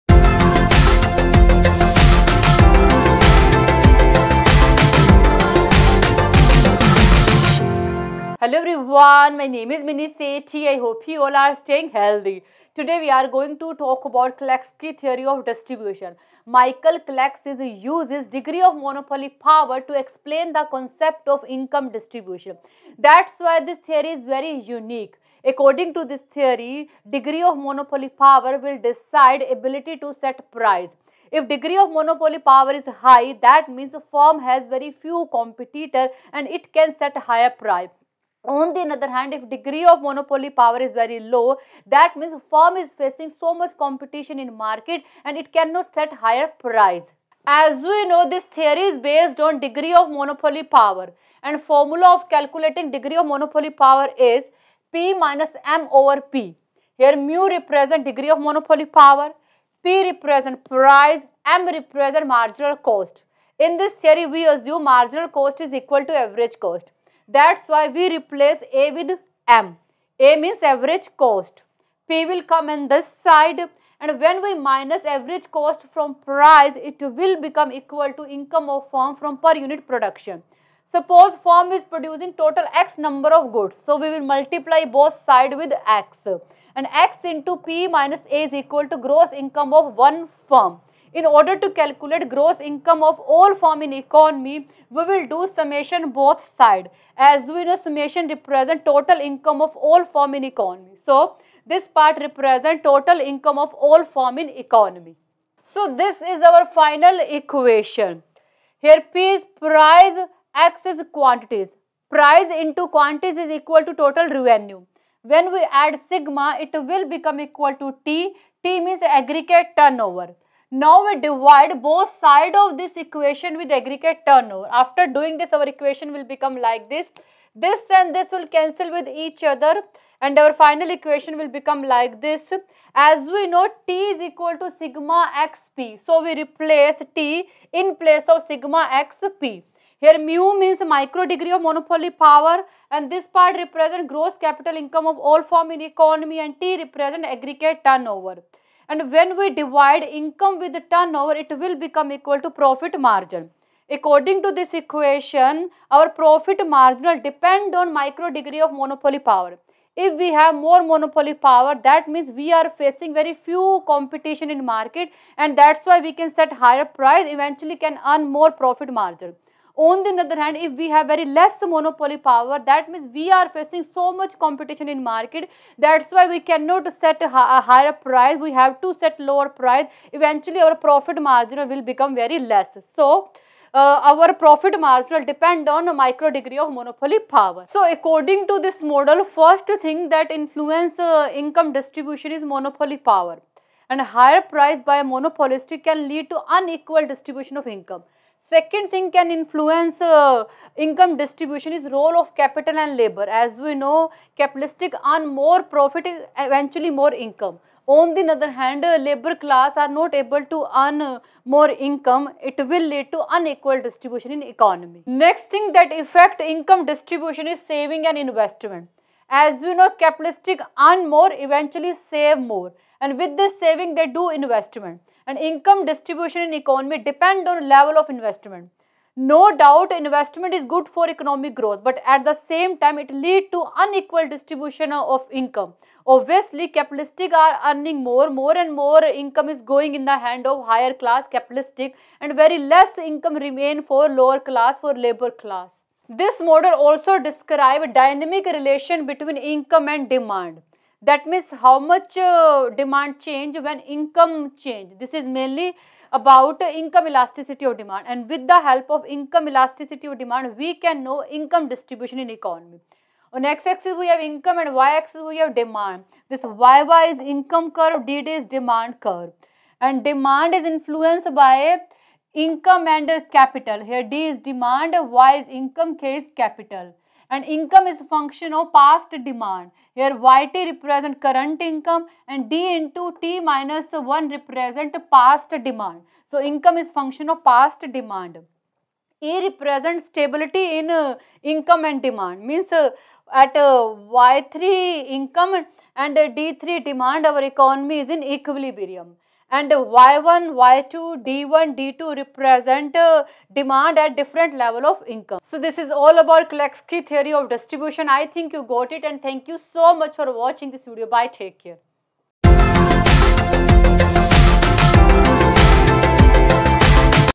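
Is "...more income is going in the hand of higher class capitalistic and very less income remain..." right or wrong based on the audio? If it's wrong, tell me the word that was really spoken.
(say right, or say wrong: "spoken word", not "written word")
right.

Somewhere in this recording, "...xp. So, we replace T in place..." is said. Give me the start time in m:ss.
2:15.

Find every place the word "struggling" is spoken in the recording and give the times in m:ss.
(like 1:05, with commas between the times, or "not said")
not said.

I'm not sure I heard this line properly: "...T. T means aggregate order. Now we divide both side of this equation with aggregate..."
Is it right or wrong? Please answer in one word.
wrong.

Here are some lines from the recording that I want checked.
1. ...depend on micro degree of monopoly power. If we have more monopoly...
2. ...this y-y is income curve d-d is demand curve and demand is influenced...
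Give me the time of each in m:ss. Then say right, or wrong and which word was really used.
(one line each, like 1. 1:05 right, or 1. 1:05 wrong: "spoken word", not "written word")
1. 2:37 right
2. 4:26 right.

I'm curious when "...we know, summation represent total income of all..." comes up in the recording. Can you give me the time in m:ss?
1:37.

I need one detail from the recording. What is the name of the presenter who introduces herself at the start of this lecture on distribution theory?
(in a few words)
Mini Sethi.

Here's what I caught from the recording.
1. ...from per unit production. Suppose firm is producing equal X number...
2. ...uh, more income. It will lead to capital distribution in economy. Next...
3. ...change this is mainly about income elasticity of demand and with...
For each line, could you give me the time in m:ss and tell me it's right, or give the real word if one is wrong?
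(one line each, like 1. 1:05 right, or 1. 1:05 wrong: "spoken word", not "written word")
1. 1:19 wrong: "total", not "equal"
2. 3:31 wrong: "unequal", not "capital"
3. 4:14 right.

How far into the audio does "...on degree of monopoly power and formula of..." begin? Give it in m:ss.
0:49.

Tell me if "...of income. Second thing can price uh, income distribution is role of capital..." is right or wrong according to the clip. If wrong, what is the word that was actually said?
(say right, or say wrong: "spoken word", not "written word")
wrong: "influence", not "price".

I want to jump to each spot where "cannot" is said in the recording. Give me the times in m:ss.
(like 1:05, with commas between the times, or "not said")
0:45, 2:56.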